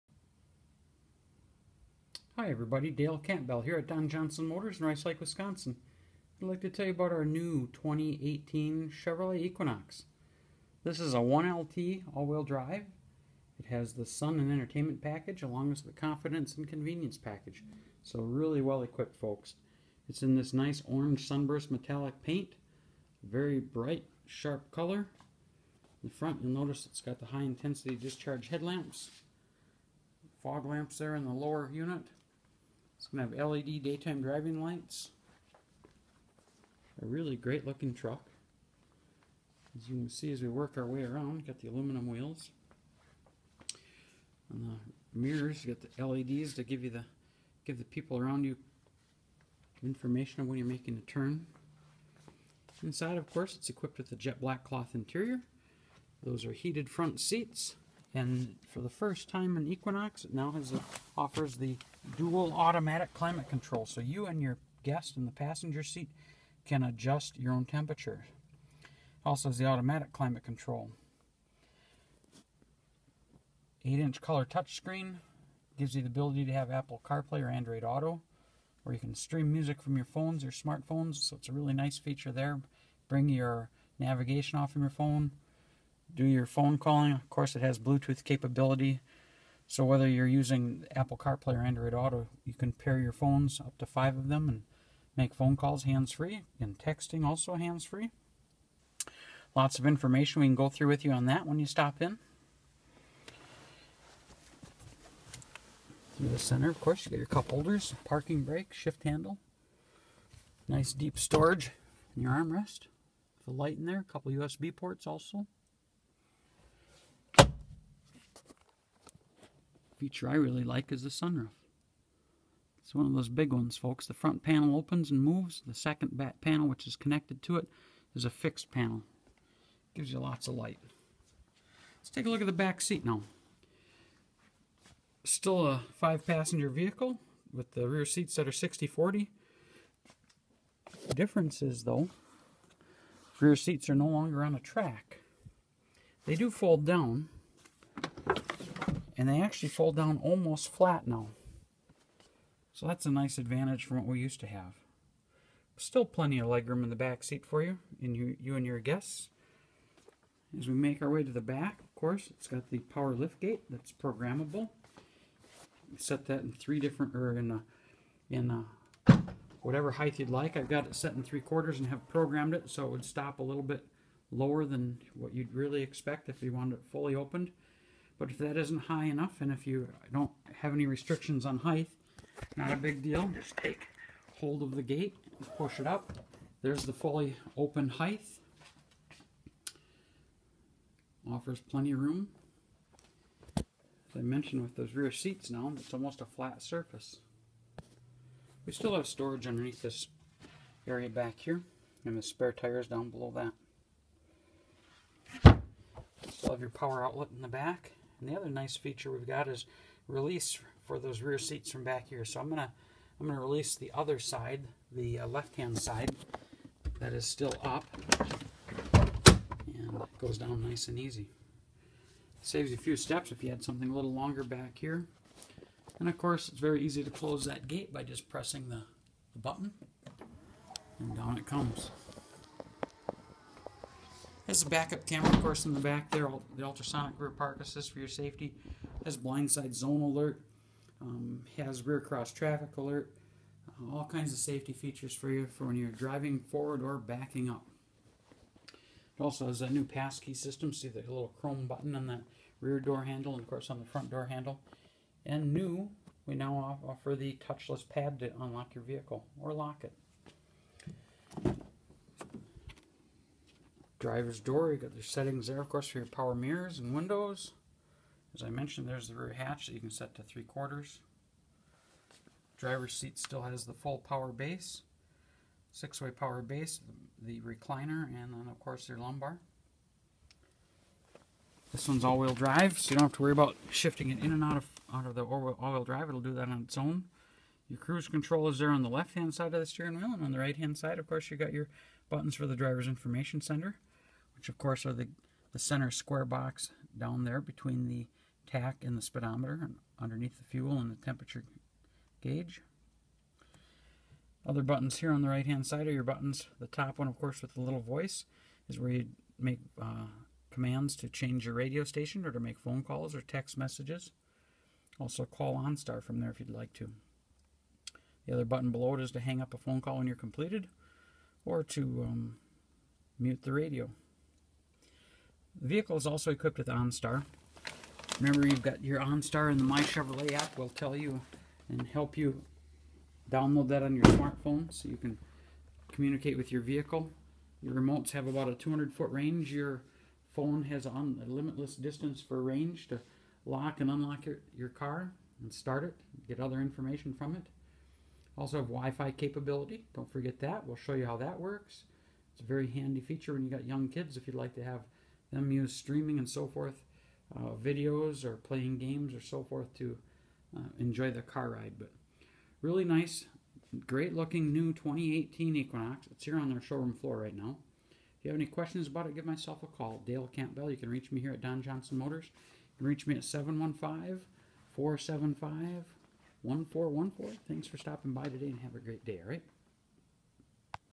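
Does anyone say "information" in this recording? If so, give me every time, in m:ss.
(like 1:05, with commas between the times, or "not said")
0:49, 1:39, 4:52, 5:46.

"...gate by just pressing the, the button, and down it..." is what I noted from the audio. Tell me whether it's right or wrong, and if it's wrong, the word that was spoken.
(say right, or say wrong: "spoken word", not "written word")
right.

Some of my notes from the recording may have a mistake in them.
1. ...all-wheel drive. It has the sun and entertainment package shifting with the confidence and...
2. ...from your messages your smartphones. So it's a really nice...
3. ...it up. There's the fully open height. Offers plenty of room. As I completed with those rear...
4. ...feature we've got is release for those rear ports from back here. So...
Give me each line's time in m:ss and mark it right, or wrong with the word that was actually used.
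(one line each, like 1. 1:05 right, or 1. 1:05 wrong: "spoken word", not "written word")
1. 0:12 wrong: "along", not "shifting"
2. 1:19 wrong: "phones", not "messages"
3. 3:05 wrong: "mentioned", not "completed"
4. 3:28 wrong: "seats", not "ports".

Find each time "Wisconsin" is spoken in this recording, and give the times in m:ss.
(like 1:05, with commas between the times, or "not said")
0:05.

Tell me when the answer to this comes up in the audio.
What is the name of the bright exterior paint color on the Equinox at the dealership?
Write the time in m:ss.
0:20.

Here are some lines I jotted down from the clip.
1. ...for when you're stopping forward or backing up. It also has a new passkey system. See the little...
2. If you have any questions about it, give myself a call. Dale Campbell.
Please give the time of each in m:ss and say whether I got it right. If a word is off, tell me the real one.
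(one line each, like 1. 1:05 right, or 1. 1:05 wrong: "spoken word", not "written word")
1. 4:05 wrong: "driving", not "stopping"
2. 6:08 right.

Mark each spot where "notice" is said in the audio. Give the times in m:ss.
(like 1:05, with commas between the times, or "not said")
0:26.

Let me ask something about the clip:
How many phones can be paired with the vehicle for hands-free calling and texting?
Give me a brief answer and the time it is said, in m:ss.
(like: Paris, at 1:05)
5, at 1:33.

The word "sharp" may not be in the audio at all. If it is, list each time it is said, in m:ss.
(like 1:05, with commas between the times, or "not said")
0:24.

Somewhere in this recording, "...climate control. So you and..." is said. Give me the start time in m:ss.
1:03.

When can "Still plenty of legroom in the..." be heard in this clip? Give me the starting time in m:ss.
2:35.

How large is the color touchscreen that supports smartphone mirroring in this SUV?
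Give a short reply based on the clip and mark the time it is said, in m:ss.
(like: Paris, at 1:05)
8-inch, at 1:13.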